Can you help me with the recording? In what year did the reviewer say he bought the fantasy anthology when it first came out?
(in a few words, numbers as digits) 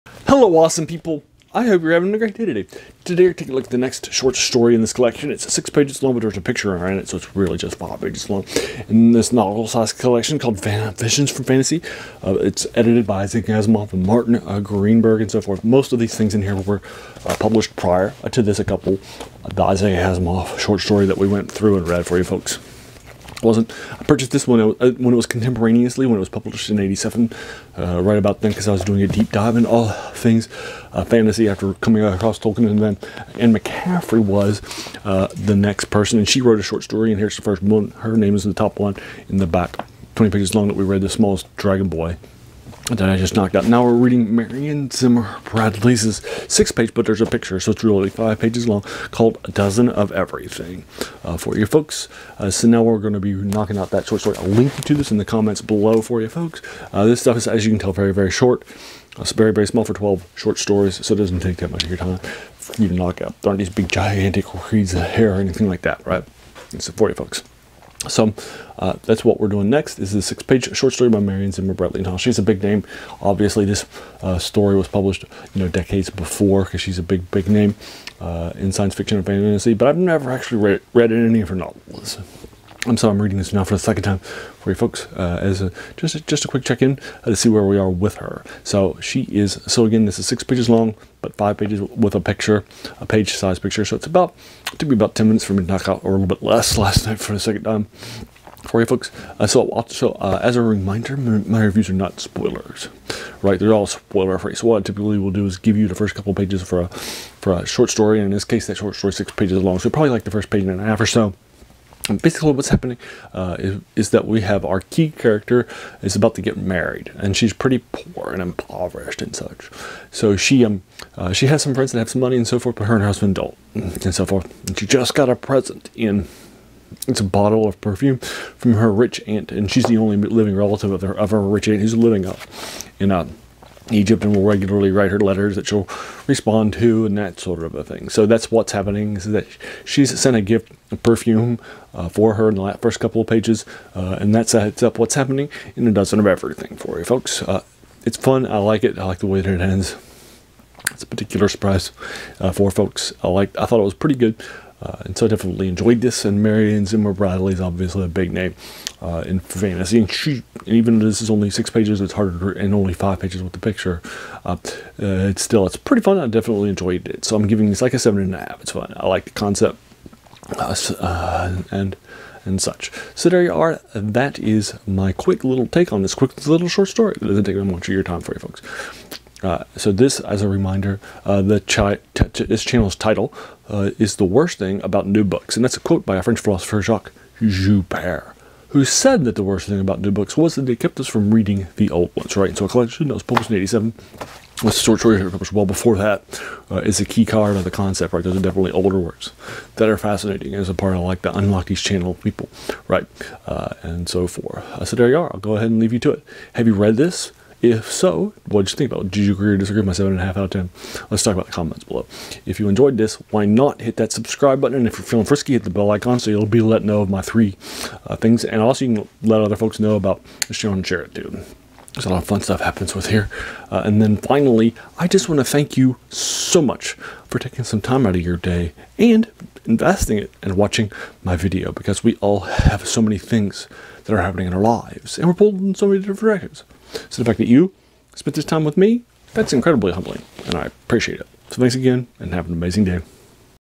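1987.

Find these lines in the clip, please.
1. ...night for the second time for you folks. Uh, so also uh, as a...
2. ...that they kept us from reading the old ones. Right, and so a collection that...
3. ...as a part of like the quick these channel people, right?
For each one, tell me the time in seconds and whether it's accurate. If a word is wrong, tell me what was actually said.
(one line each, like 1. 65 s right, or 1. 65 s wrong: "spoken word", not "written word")
1. 97 s right
2. 190 s right
3. 200 s wrong: "unlock", not "quick".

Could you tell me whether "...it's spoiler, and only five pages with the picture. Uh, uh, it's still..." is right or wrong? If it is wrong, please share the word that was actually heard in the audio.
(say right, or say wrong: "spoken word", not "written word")
wrong: "harder", not "spoiler".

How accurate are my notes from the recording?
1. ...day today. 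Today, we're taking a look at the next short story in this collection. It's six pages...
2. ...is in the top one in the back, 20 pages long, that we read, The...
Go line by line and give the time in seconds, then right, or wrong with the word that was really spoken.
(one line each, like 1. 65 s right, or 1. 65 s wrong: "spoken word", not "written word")
1. 2 s right
2. 38 s right.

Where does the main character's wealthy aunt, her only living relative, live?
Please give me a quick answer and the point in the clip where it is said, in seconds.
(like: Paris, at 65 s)
Egypt, at 133 s.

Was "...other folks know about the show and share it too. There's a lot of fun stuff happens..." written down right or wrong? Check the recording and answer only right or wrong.
right.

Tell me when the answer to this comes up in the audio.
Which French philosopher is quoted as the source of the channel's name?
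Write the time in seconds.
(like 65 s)
186 s.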